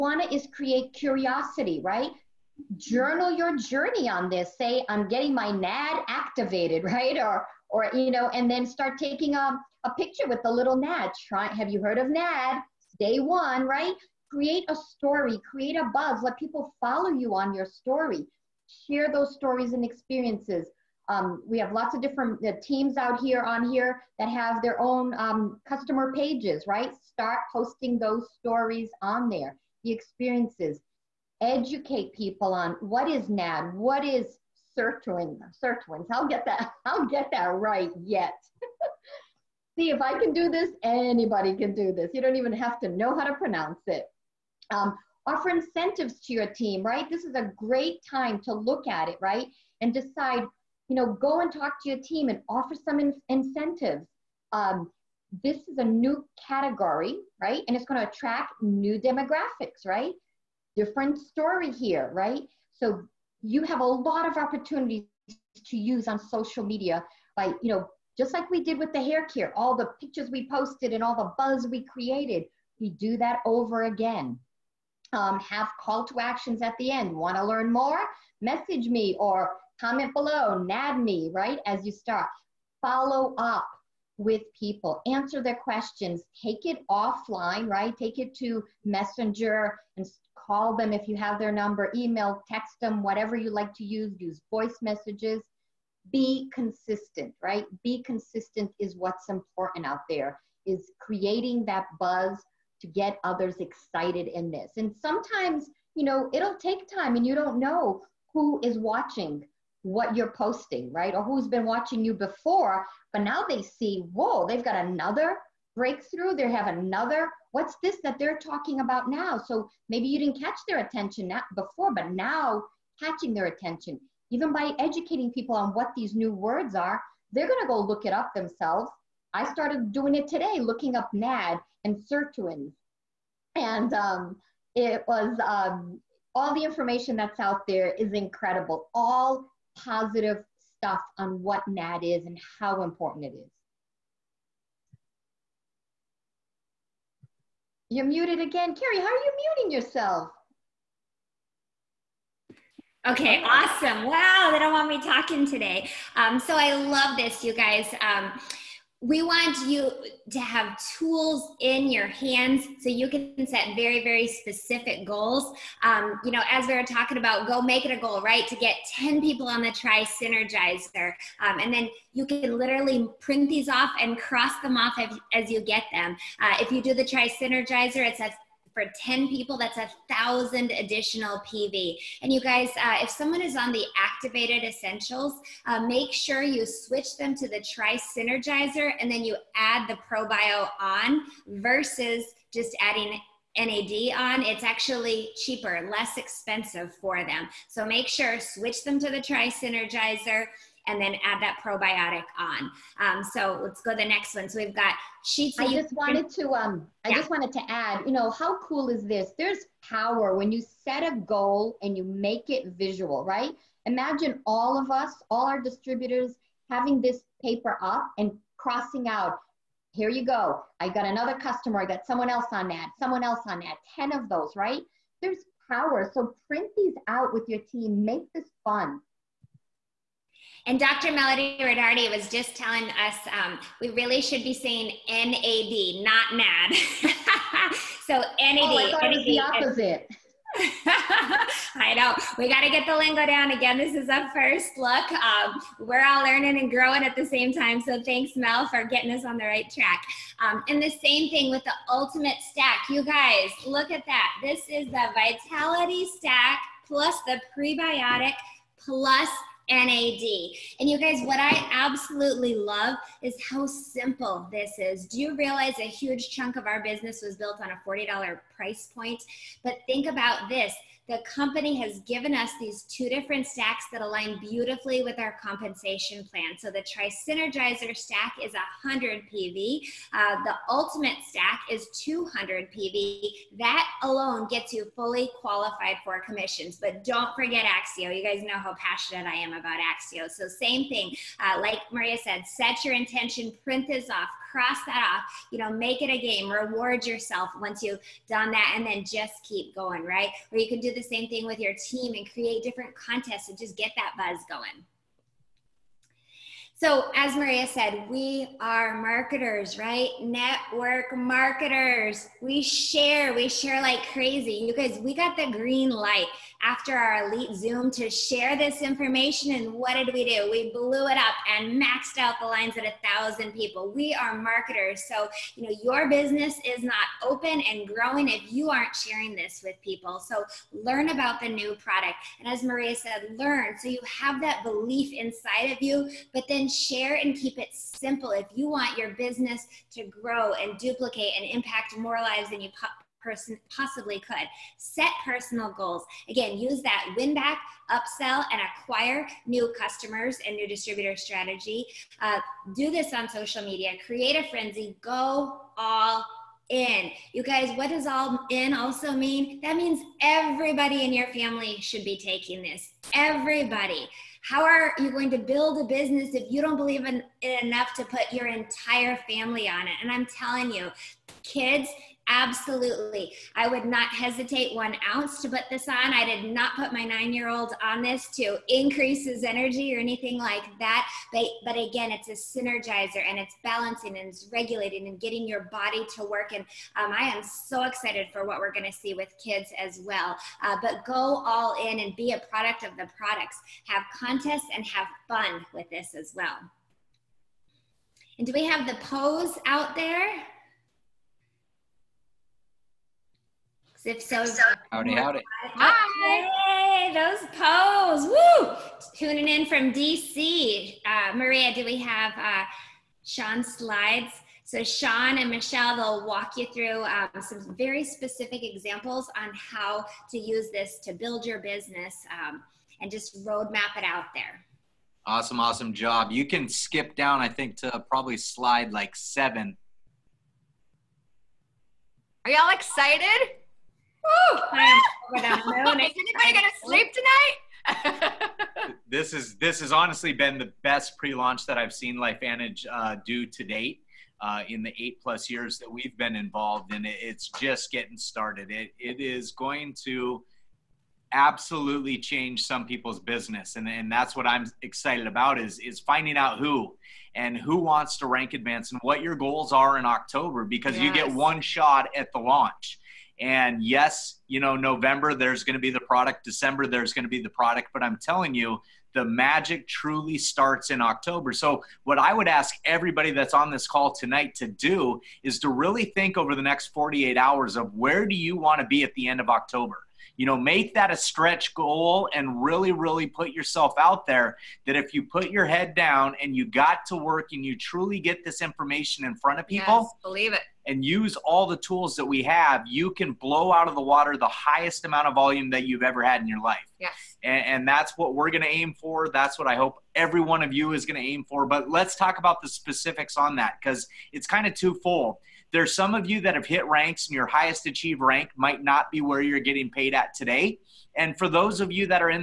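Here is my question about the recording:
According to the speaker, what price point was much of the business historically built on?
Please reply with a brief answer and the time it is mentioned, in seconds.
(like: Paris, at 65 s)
$40, at 267 s.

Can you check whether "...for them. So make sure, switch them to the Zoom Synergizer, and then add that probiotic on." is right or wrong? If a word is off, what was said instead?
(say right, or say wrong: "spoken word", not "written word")
wrong: "Tri", not "Zoom".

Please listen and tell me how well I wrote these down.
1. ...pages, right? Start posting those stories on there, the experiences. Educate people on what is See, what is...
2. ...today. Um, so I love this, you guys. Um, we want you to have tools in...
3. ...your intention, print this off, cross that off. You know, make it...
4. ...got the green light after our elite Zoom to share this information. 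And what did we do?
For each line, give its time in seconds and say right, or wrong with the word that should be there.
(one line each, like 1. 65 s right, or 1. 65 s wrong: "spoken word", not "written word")
1. 26 s wrong: "NAD", not "See"
2. 155 s right
3. 292 s right
4. 315 s right.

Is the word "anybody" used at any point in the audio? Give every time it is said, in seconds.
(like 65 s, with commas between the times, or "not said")
40 s, 435 s.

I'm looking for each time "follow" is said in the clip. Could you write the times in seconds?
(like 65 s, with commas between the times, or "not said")
16 s, 82 s.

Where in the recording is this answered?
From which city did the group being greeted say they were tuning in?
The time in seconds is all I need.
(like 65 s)
409 s.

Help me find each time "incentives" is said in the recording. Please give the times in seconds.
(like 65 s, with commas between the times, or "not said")
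45 s, 53 s.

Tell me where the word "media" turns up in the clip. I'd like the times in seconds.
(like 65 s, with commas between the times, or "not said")
66 s, 353 s.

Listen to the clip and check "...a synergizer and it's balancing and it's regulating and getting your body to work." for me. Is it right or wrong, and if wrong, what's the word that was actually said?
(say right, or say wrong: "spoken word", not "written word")
right.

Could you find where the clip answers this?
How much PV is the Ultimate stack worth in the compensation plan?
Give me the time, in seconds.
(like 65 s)
281 s.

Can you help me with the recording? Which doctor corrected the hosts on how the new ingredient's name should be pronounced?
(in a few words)
Melody Rodarte.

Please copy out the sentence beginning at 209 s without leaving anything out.
There's power when you set a goal and you make it visual, right?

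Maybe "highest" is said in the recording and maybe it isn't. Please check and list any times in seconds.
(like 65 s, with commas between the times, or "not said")
494 s, 507 s.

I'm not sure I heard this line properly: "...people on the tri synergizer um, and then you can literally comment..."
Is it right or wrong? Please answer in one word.
wrong.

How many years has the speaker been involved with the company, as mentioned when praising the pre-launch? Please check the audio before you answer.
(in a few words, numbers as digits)
eight plus.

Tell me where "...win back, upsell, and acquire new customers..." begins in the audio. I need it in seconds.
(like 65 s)
347 s.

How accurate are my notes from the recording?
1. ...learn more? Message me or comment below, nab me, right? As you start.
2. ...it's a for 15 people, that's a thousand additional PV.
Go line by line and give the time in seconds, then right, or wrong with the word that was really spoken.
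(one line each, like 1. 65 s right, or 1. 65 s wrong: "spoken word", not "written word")
1. 77 s right
2. 177 s wrong: "10", not "15".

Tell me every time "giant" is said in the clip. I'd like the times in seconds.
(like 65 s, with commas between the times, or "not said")
not said.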